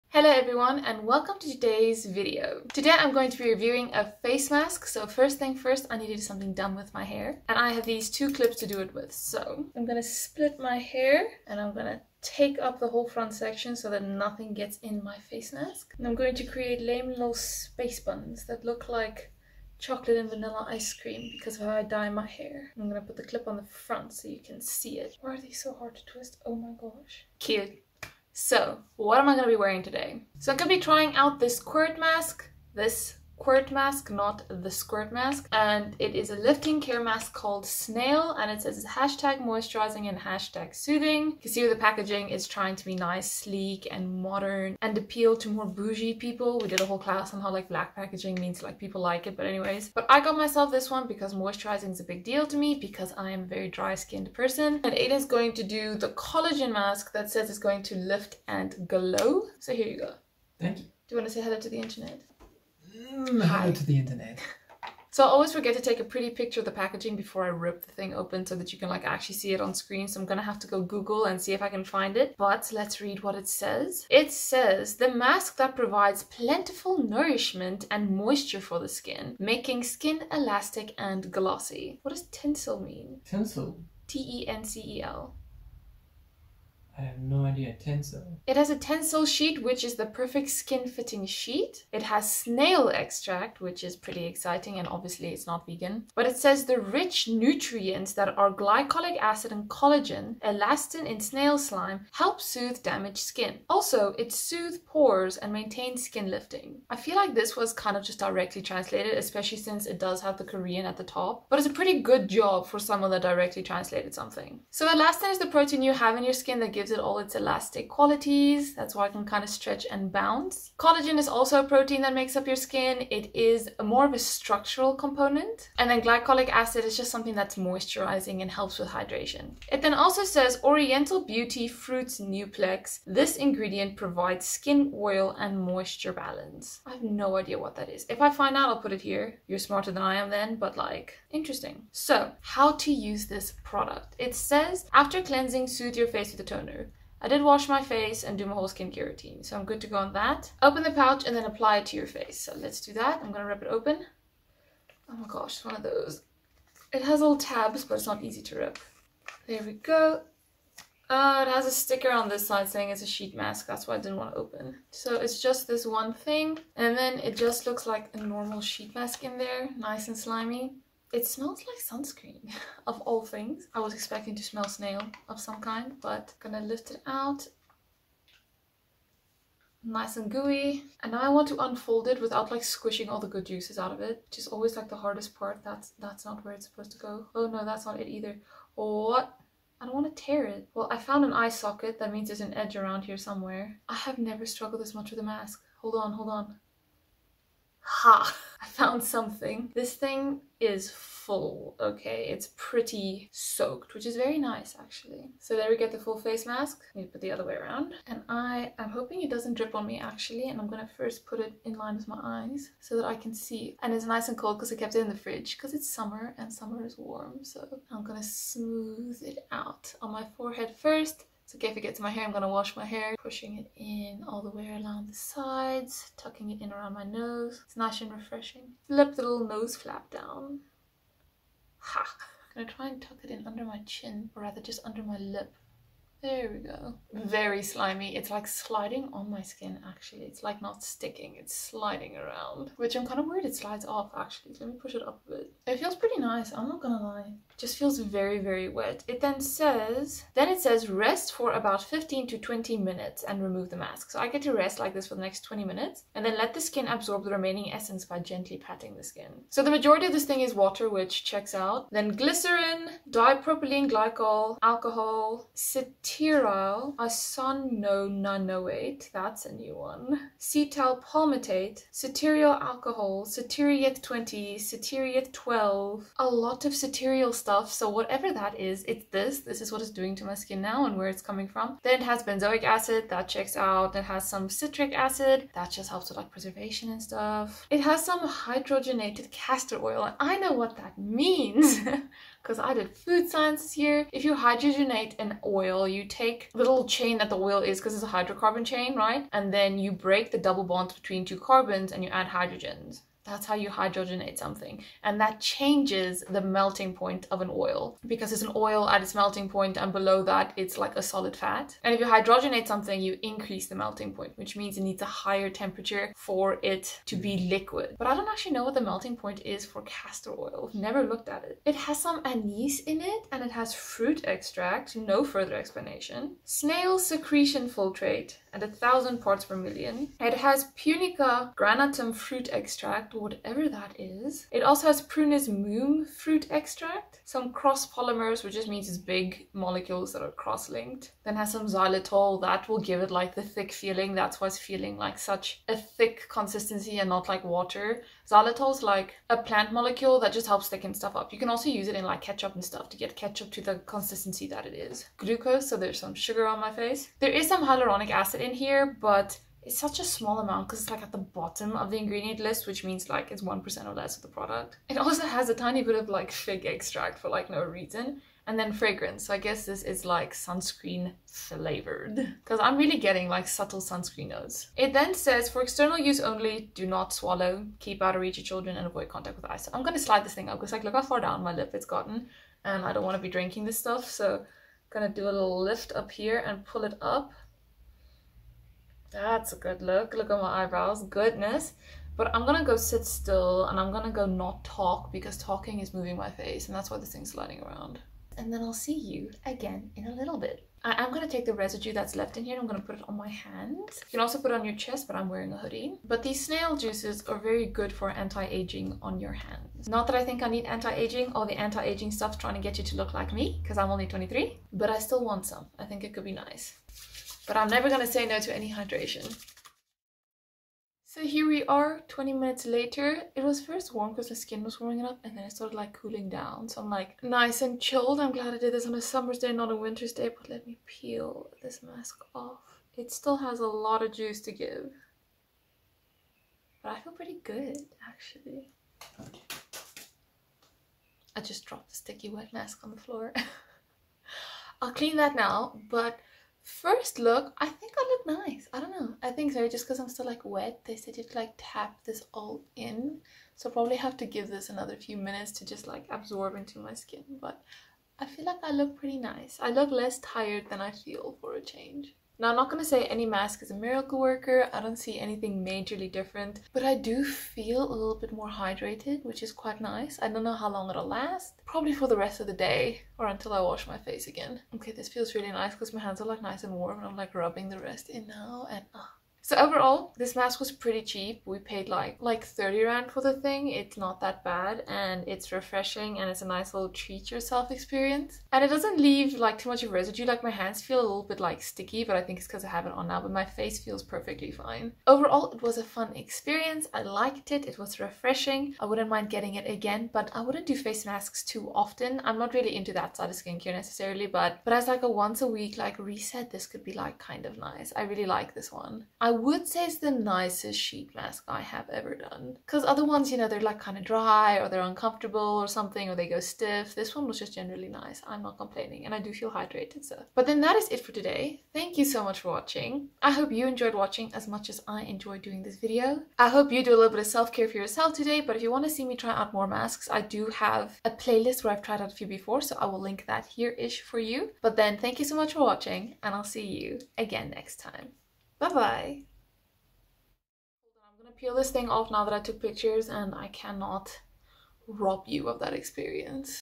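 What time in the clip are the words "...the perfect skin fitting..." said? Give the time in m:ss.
1:29.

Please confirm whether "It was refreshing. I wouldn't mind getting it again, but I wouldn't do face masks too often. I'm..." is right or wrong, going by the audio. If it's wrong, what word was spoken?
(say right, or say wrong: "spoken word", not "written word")
right.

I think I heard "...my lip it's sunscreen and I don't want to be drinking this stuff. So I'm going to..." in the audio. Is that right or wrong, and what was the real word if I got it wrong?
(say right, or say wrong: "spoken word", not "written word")
wrong: "gotten", not "sunscreen".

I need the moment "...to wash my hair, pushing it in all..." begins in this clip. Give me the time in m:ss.
3:42.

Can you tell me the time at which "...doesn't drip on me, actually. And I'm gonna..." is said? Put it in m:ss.
3:29.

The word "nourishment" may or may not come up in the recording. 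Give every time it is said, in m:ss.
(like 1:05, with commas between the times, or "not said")
1:17.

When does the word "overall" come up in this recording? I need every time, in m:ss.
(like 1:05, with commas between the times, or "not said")
7:59, 8:15.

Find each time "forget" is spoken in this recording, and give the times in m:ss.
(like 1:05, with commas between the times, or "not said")
1:05.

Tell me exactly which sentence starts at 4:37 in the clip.
So whatever that is, it's this.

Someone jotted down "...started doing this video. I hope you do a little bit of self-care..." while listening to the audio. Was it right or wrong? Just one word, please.
wrong.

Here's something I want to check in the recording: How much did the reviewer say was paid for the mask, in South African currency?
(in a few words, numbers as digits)
30 rand.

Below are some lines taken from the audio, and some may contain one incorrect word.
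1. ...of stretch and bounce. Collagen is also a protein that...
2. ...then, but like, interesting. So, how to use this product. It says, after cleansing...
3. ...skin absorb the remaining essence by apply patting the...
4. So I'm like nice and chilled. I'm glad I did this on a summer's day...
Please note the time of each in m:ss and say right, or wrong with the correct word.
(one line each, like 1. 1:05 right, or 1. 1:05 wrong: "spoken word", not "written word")
1. 1:59 right
2. 2:20 right
3. 4:16 wrong: "gently", not "apply"
4. 7:06 right.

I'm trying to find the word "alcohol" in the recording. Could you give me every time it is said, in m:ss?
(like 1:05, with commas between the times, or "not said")
4:24, 4:32.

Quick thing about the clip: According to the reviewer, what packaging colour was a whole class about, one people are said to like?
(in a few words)
Black.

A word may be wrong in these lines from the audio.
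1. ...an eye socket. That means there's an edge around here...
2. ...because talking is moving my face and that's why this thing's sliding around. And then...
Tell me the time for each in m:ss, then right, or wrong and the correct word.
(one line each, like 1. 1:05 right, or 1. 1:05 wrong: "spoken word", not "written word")
1. 3:11 right
2. 6:35 right.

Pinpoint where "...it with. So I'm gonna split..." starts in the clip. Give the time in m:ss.
0:08.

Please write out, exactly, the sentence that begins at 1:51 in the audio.
But it's a pretty good job for someone that directly translated something.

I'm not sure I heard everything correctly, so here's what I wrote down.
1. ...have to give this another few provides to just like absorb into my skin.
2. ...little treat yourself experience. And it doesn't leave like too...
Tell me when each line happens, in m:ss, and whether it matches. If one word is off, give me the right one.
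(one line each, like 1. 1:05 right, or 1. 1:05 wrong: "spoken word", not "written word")
1. 7:33 wrong: "minutes", not "provides"
2. 8:06 right.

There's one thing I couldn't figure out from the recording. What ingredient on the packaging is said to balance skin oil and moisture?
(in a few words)
Oriental Beauty Fruits Nuplex.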